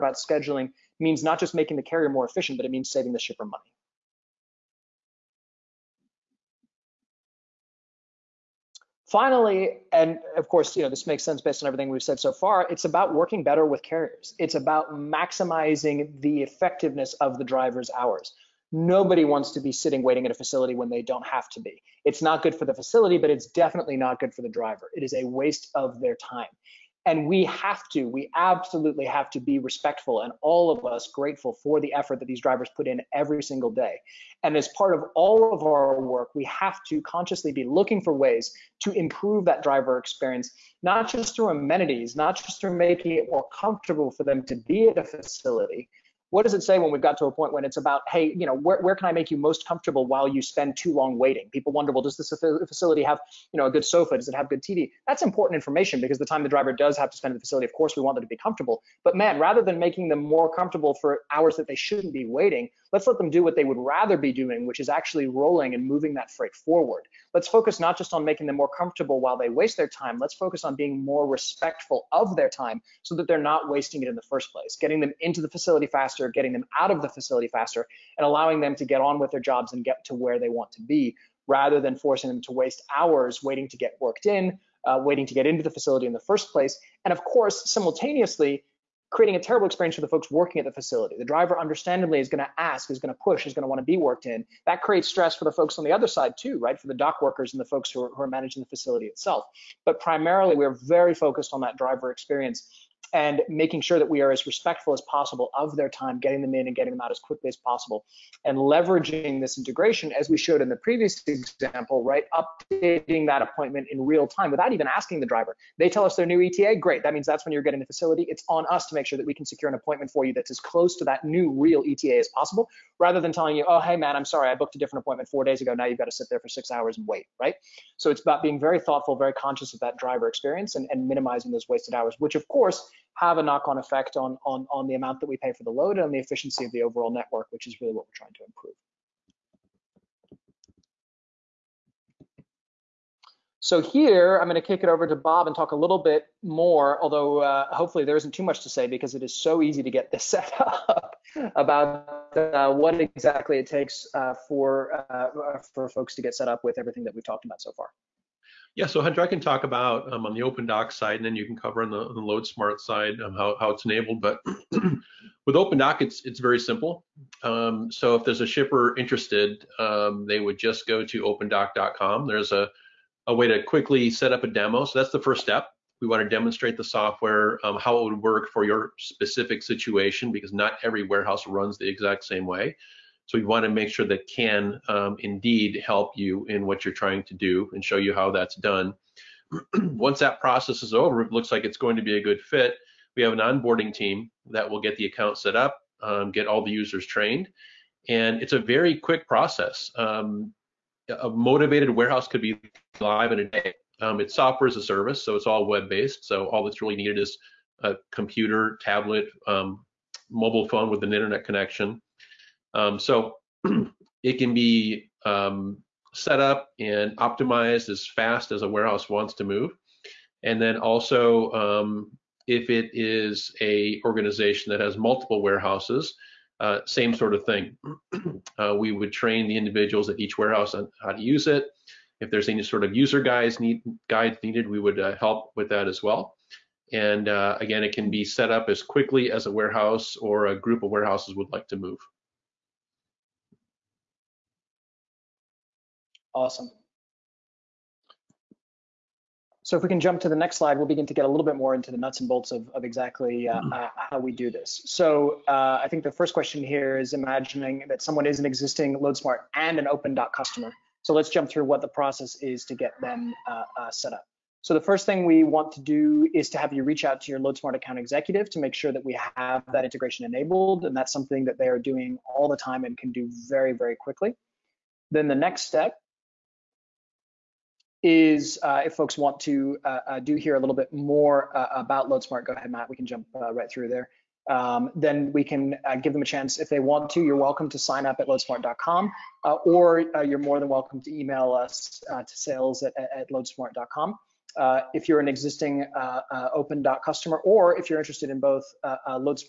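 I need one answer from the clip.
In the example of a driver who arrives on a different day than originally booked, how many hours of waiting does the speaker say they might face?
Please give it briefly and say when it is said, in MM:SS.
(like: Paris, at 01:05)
6, at 02:06.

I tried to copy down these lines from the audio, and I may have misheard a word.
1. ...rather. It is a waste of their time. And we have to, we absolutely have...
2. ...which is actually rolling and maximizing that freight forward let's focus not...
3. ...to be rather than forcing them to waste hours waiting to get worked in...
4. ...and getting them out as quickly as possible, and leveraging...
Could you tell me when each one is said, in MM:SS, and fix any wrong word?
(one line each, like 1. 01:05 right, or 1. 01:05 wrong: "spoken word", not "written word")
1. 00:24 wrong: "driver", not "rather"
2. 01:04 wrong: "moving", not "maximizing"
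3. 01:20 right
4. 01:46 right.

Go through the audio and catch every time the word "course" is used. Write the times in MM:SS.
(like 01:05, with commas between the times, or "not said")
00:10, 00:57, 01:27, 02:12.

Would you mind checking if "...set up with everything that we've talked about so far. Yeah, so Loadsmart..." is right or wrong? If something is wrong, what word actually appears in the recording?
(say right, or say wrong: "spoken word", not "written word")
wrong: "Hendra", not "Loadsmart".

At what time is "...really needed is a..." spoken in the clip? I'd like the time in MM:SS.
03:26.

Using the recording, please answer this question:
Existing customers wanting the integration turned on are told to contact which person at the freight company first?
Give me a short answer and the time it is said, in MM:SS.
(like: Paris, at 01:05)
Loadsmart account executive, at 04:27.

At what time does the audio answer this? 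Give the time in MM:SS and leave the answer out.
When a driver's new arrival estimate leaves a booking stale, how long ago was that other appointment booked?
02:05.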